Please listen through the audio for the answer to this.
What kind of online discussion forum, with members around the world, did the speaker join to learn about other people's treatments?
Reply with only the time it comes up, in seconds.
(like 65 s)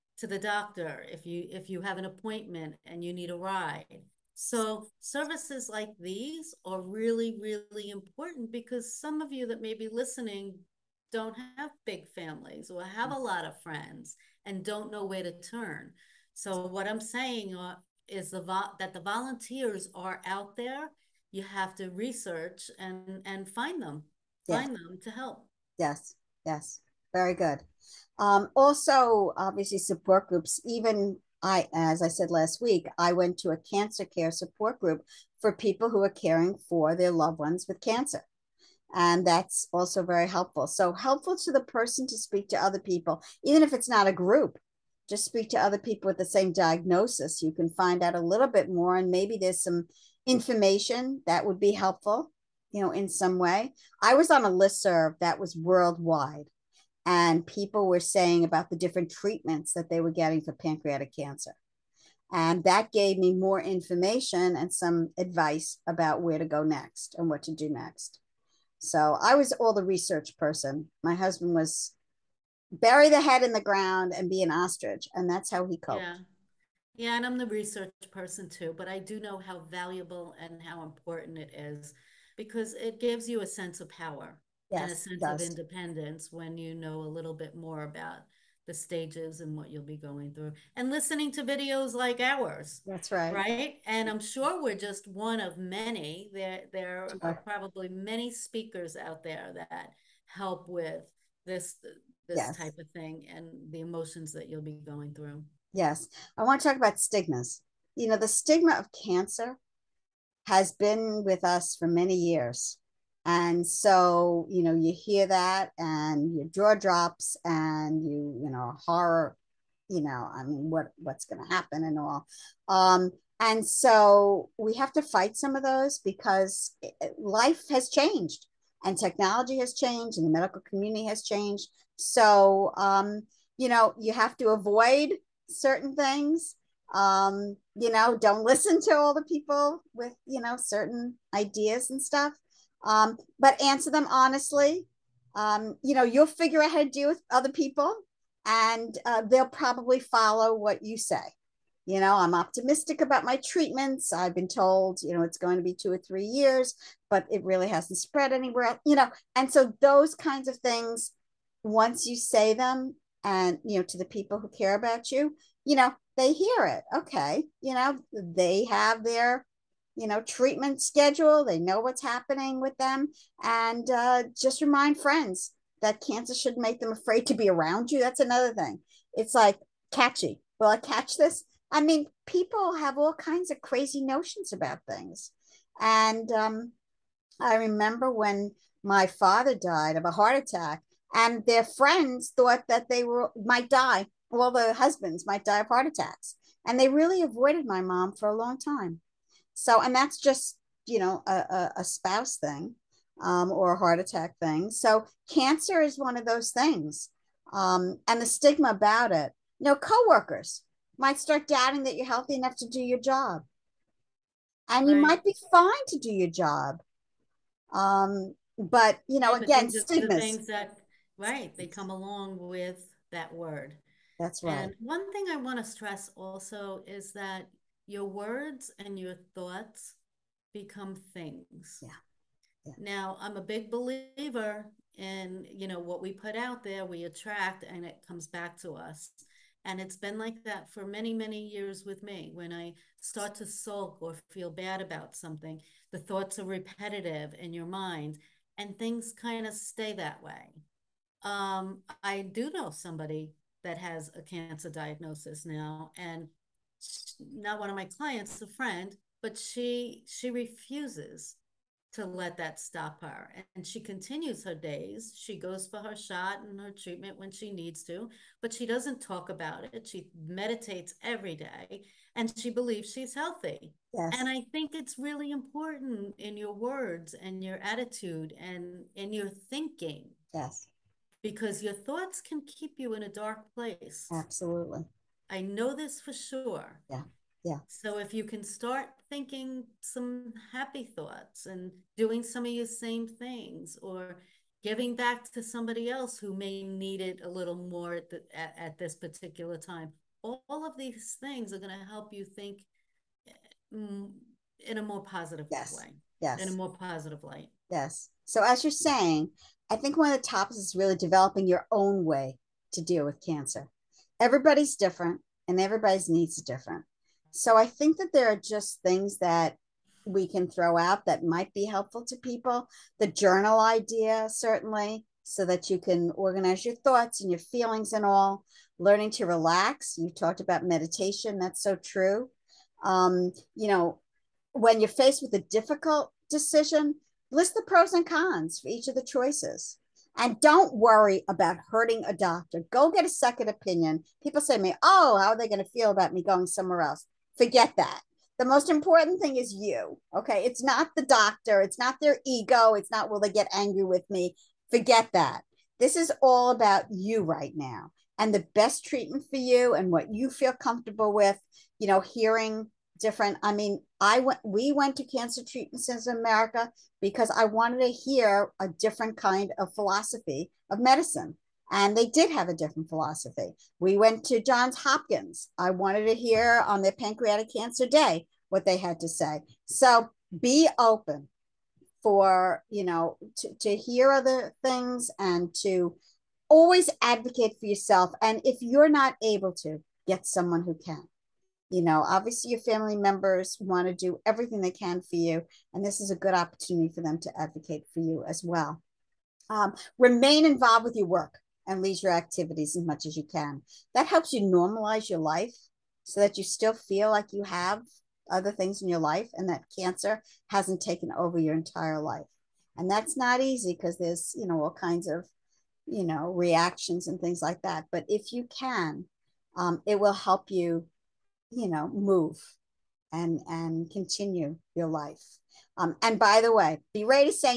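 54 s.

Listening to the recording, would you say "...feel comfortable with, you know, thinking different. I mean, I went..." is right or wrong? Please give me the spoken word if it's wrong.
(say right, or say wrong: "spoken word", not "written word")
wrong: "hearing", not "thinking".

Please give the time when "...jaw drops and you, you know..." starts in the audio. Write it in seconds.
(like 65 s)
116 s.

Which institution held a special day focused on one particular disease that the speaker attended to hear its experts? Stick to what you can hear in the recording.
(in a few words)
Johns Hopkins.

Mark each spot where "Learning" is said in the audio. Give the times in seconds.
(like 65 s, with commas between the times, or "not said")
328 s.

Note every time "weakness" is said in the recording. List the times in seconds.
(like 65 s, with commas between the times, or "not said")
not said.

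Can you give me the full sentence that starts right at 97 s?
are probably many speakers out there that help with this this yes.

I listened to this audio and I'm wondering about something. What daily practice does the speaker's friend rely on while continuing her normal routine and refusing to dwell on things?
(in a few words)
Meditation.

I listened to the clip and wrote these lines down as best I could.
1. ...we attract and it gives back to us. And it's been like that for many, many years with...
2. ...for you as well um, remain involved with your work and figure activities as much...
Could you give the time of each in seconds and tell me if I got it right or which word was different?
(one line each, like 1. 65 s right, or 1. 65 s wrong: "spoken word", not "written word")
1. 236 s wrong: "comes", not "gives"
2. 397 s wrong: "leisure", not "figure".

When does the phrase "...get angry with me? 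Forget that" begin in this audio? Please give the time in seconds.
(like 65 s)
353 s.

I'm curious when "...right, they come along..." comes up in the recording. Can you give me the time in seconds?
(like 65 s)
221 s.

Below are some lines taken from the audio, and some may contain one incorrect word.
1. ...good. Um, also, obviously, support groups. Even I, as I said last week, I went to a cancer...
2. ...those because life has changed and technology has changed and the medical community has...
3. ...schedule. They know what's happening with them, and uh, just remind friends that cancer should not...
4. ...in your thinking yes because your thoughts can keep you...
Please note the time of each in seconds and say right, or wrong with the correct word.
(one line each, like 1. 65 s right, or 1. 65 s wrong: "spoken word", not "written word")
1. 27 s right
2. 125 s right
3. 170 s right
4. 278 s right.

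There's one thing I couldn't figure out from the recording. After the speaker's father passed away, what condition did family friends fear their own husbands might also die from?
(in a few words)
Heart attacks.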